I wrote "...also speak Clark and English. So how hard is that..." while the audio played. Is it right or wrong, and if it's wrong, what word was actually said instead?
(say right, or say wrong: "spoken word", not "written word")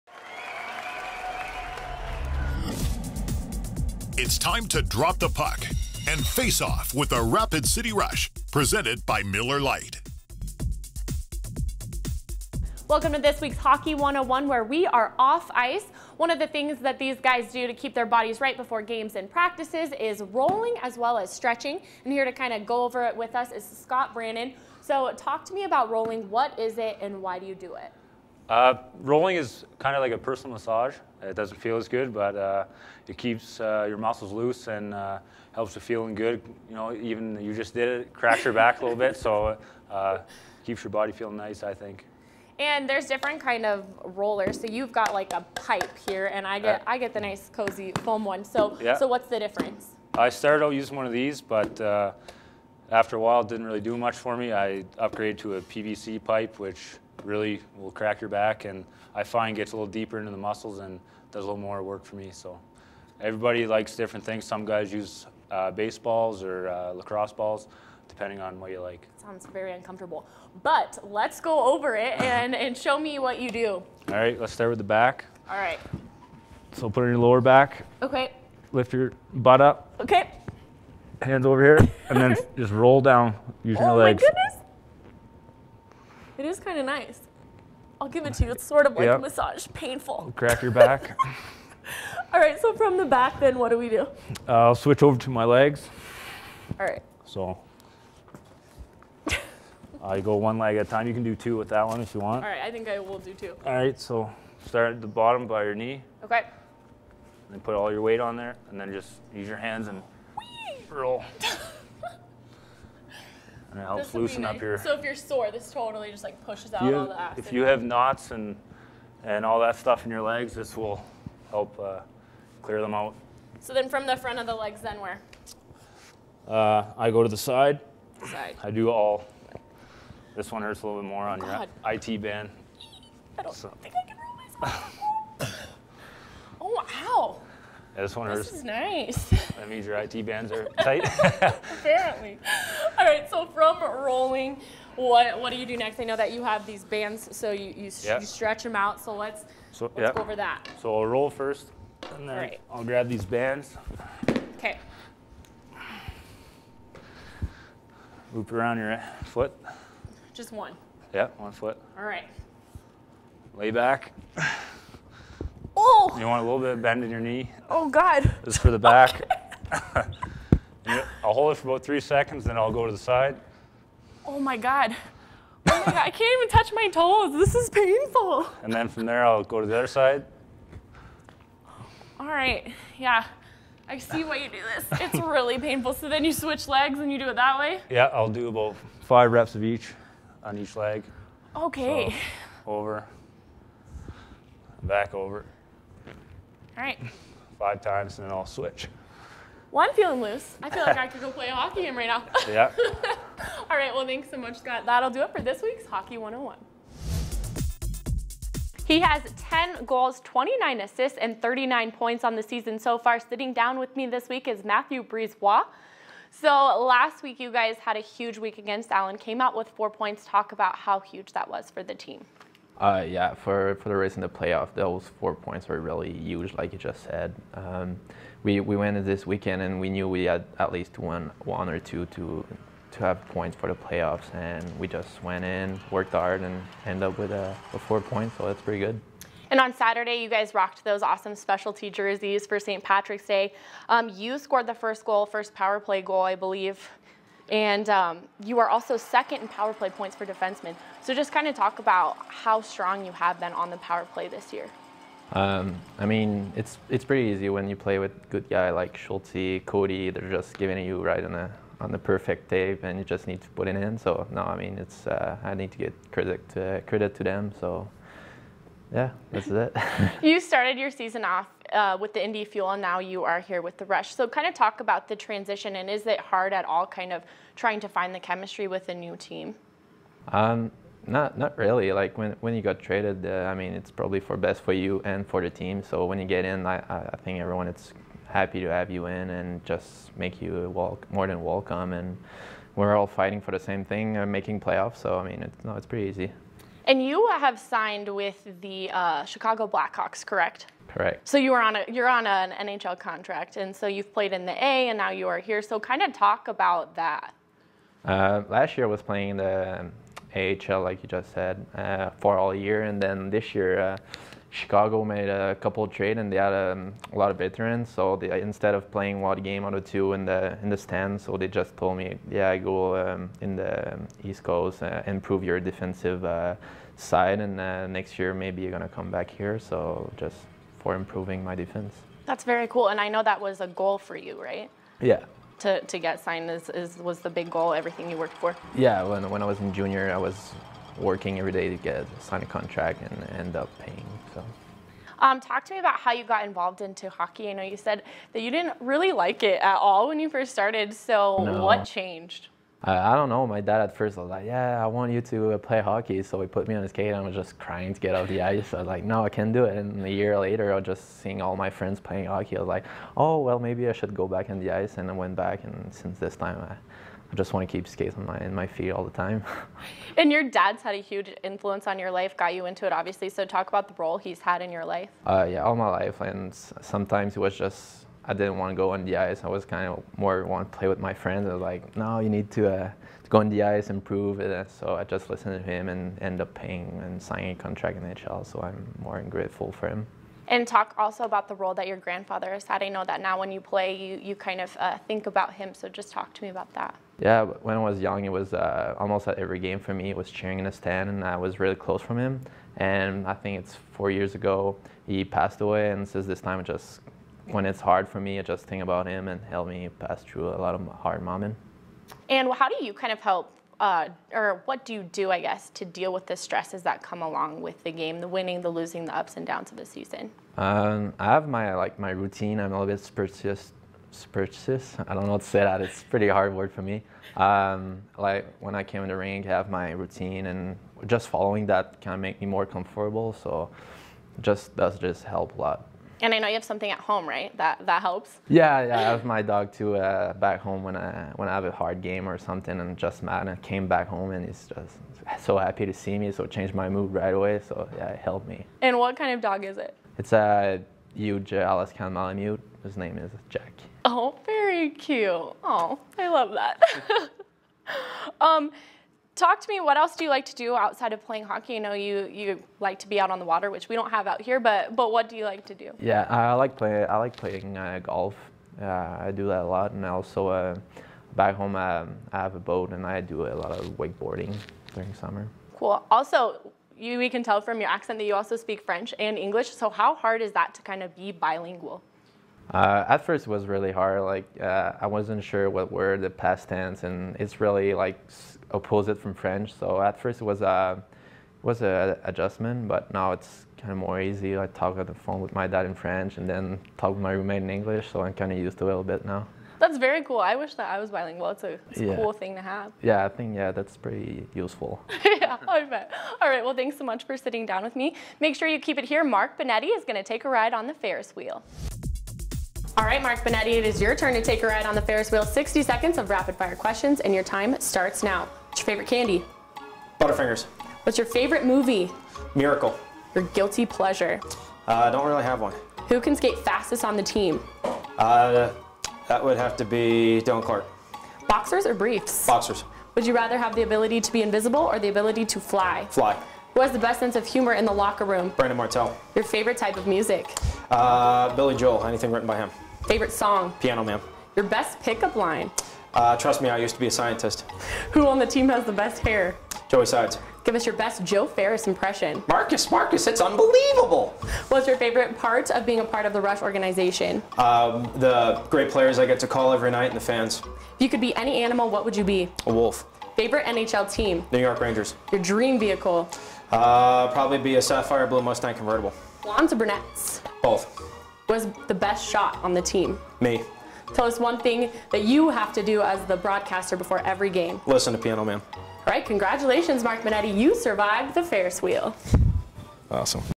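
wrong: "French", not "Clark".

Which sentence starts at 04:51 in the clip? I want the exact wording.
And we're all fighting for the same thing, uh, making playoffs.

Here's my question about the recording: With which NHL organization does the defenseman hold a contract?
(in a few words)
Chicago Blackhawks.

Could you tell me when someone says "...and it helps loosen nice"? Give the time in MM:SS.
01:53.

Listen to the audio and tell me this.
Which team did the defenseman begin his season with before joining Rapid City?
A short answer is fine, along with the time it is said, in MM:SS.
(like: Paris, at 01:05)
Indy Fuel, at 04:32.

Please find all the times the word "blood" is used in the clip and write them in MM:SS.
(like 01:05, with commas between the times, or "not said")
not said.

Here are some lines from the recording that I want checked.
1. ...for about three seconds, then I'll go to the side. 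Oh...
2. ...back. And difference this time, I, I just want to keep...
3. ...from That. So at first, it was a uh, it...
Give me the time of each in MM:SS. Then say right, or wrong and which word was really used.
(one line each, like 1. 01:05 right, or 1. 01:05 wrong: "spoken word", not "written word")
1. 02:51 right
2. 06:05 wrong: "since", not "difference"
3. 08:09 wrong: "French", not "That".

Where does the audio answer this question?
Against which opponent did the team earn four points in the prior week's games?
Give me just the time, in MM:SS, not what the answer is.
03:38.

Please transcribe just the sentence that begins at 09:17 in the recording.
Um, the great players I get to call every night and the fans.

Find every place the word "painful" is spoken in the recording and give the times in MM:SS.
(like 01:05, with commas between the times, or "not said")
01:29, 02:57, 03:05.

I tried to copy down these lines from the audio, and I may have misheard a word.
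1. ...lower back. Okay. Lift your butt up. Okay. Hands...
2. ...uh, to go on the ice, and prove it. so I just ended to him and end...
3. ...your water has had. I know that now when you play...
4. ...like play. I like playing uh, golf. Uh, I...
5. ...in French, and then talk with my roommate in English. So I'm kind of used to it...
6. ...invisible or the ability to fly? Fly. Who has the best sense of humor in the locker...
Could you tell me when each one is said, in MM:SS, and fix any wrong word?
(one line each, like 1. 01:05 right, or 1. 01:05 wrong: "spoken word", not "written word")
1. 01:17 right
2. 06:22 wrong: "listened", not "ended"
3. 06:31 wrong: "grandfather", not "water"
4. 07:46 right
5. 08:15 right
6. 08:54 right.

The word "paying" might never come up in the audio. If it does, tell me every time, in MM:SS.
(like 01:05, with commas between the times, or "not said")
05:43, 06:26.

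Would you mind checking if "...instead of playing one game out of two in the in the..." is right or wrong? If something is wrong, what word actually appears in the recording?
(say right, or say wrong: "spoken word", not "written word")
right.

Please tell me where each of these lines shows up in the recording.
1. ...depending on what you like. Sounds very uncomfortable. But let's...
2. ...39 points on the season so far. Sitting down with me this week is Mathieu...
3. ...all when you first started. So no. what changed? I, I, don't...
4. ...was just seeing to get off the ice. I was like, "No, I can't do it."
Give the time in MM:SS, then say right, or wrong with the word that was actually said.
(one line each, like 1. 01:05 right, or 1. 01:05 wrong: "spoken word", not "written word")
1. 01:08 right
2. 03:31 right
3. 05:49 right
4. 05:57 wrong: "crying", not "seeing".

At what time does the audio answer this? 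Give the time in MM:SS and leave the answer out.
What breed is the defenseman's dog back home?
07:31.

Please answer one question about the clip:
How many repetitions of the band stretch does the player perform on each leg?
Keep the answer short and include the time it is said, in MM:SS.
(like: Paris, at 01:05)
5, at 03:09.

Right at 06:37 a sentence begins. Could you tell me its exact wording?
Yeah, when I was young, it was uh, almost at every game for me.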